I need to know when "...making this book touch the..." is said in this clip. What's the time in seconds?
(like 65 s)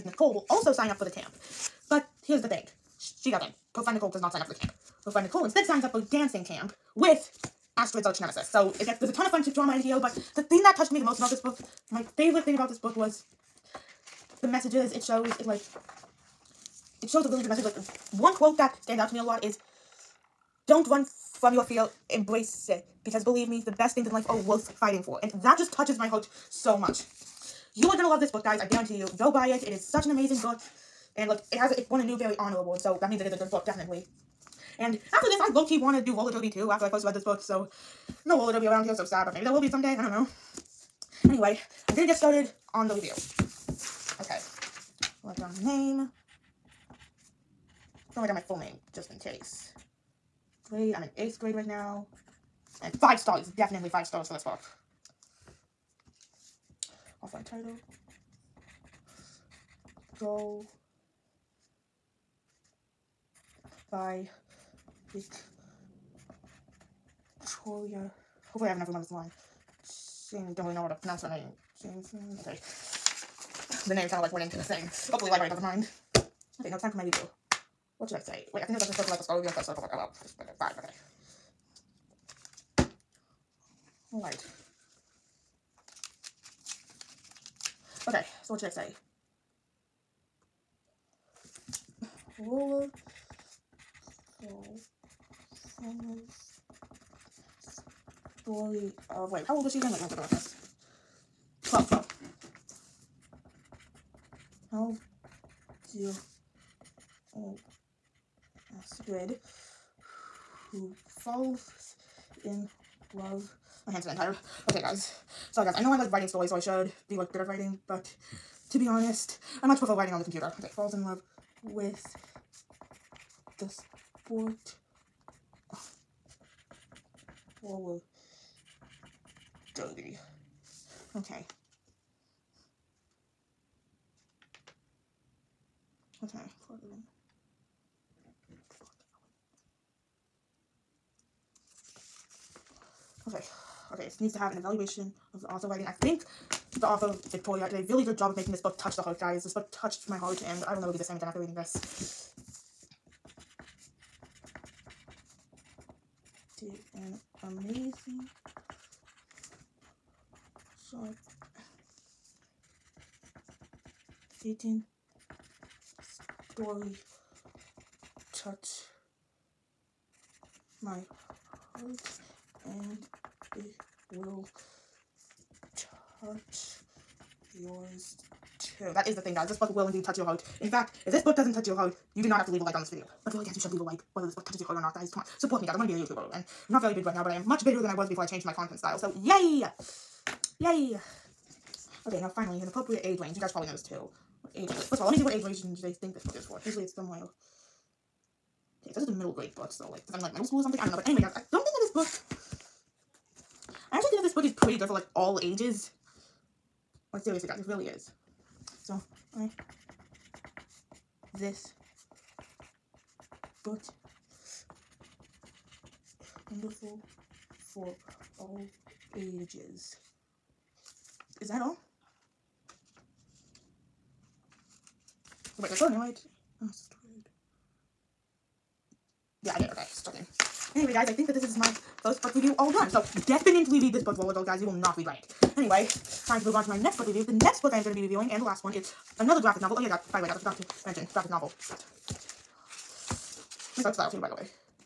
148 s.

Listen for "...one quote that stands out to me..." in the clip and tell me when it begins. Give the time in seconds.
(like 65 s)
18 s.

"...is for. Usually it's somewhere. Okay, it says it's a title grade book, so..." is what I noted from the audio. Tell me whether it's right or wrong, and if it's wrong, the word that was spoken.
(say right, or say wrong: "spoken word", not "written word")
wrong: "middle", not "title".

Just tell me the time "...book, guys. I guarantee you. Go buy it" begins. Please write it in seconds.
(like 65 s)
28 s.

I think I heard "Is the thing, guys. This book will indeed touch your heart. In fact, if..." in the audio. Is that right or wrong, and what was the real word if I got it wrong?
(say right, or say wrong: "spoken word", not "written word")
right.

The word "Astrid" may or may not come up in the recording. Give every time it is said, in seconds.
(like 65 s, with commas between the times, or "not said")
7 s, 108 s.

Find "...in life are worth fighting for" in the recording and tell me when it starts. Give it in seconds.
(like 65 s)
24 s.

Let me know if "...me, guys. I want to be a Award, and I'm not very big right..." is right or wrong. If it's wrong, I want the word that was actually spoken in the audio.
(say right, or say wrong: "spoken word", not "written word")
wrong: "YouTuber", not "Award".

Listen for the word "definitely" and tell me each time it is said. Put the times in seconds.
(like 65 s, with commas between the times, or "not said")
33 s, 53 s, 233 s.